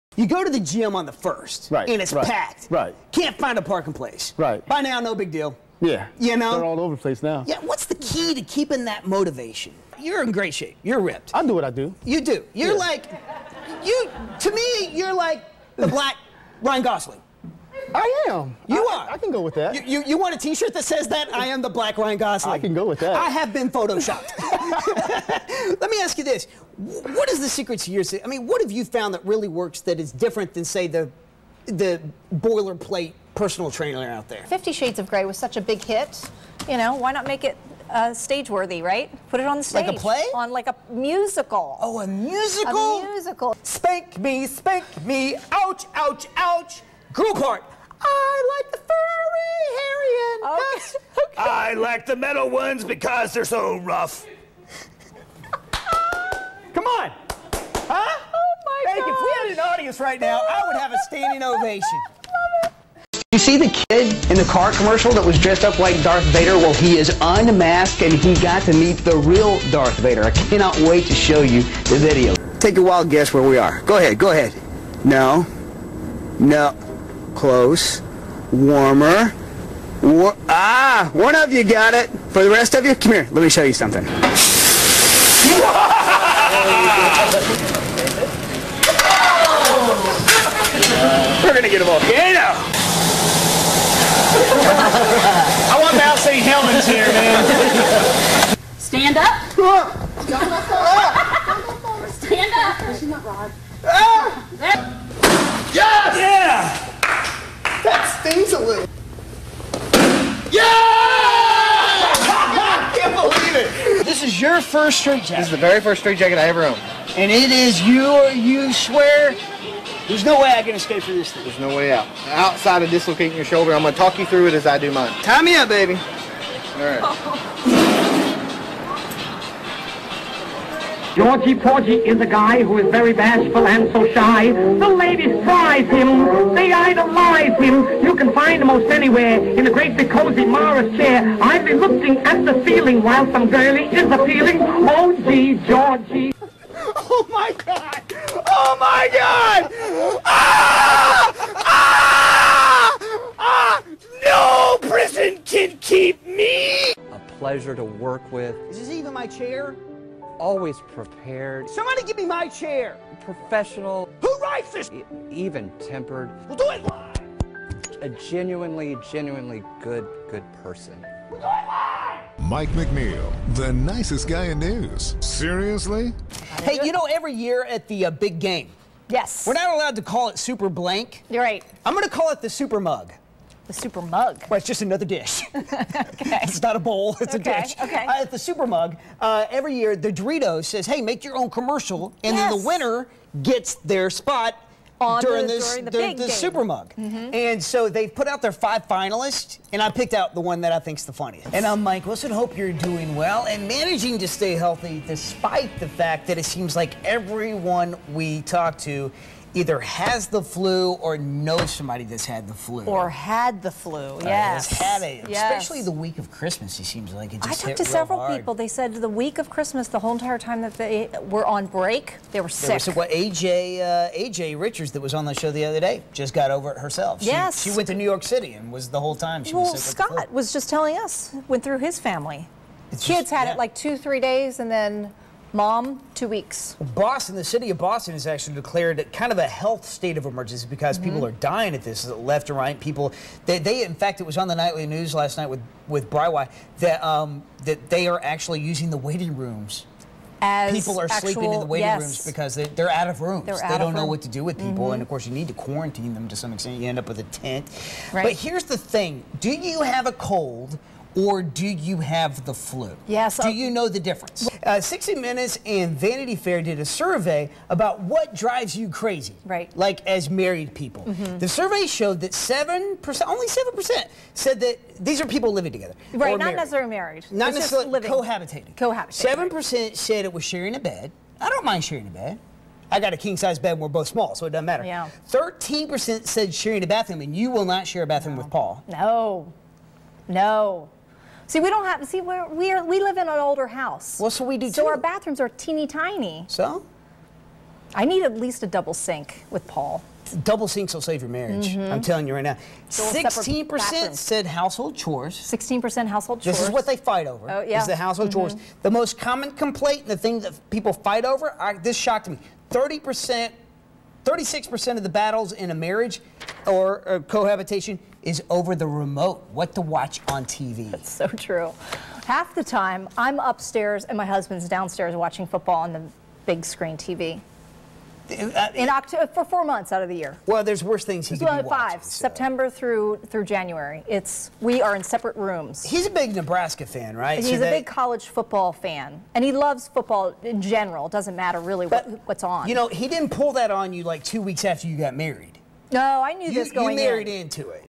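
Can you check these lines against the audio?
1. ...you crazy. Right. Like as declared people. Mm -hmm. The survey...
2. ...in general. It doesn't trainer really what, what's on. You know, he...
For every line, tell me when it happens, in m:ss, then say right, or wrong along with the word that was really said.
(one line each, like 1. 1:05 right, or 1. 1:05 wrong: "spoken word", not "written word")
1. 4:28 wrong: "married", not "declared"
2. 5:40 wrong: "matter", not "trainer".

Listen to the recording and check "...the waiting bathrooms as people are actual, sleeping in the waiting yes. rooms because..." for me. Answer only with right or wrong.
wrong.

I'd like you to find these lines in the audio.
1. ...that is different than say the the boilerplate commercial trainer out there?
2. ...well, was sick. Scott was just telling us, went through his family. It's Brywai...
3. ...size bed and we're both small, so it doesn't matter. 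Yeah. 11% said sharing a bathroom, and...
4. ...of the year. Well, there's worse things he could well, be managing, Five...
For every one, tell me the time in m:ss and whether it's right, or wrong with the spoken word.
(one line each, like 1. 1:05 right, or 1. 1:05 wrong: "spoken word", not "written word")
1. 0:29 wrong: "personal", not "commercial"
2. 3:49 wrong: "Kids", not "Brywai"
3. 4:43 wrong: "13", not "11"
4. 5:30 wrong: "watching", not "managing".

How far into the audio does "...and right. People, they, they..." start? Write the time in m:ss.
4:02.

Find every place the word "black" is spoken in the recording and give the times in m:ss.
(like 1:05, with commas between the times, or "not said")
0:15, 0:21.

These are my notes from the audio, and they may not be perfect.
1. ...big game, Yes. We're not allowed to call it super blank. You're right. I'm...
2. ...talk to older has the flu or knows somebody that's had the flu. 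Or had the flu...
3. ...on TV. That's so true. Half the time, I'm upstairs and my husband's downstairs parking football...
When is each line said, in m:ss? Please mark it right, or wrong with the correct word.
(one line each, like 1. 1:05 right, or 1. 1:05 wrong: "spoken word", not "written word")
1. 2:58 right
2. 3:28 wrong: "either", not "older"
3. 5:20 wrong: "watching", not "parking".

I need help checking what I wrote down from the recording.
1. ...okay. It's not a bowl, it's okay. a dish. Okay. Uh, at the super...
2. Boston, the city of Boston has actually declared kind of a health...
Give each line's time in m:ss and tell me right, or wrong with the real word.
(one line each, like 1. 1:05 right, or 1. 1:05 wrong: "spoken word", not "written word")
1. 3:05 right
2. 3:56 right.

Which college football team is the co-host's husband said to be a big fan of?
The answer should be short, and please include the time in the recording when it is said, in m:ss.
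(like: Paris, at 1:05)
Nebraska, at 5:36.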